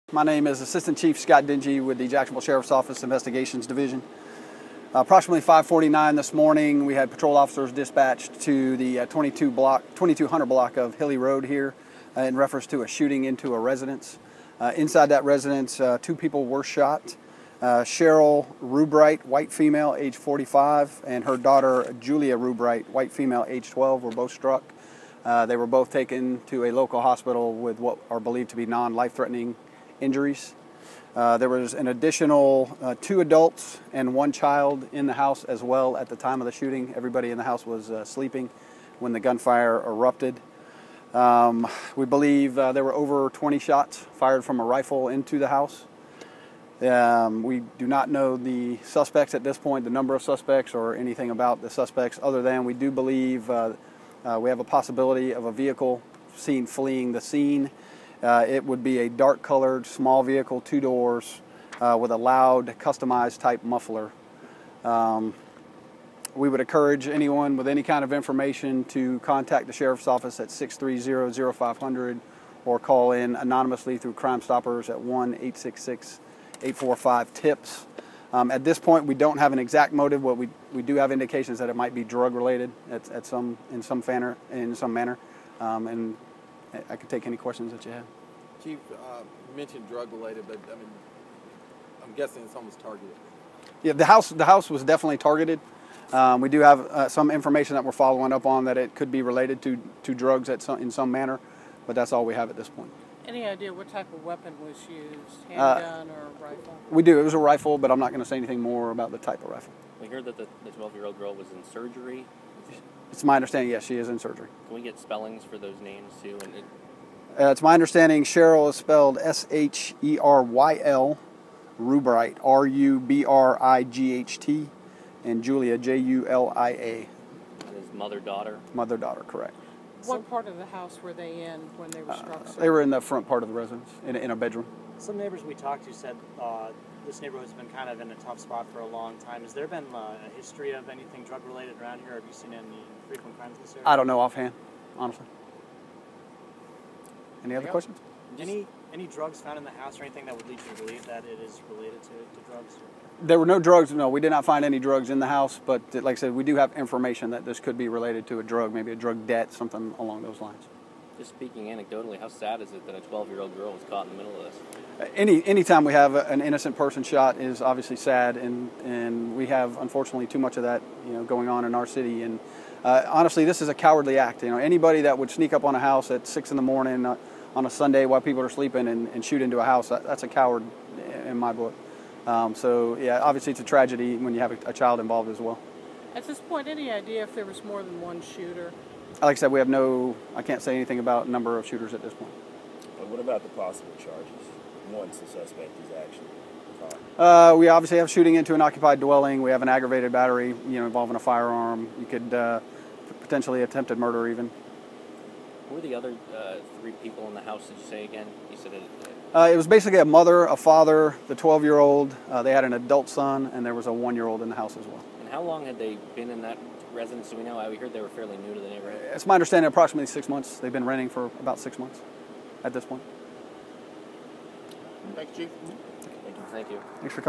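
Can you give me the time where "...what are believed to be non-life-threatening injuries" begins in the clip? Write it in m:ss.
0:27.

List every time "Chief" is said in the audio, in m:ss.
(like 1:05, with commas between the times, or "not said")
0:00, 1:28, 3:45.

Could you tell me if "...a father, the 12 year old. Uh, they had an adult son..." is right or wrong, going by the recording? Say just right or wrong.
right.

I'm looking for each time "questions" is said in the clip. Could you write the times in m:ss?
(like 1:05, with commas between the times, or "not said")
1:27, 2:27.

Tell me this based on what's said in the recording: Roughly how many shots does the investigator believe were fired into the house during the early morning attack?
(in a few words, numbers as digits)
over 20.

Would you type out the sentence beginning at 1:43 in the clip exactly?
Any idea what type of weapon was used?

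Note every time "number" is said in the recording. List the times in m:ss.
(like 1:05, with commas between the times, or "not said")
0:49, 3:11.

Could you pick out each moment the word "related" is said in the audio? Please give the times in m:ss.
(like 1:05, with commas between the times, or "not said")
1:22, 1:30, 1:39, 2:21, 2:31, 2:37.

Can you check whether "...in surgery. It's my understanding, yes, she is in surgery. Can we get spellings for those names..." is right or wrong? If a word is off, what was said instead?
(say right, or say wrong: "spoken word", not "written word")
right.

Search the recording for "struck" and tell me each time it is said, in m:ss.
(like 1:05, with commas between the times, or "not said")
0:24, 2:12.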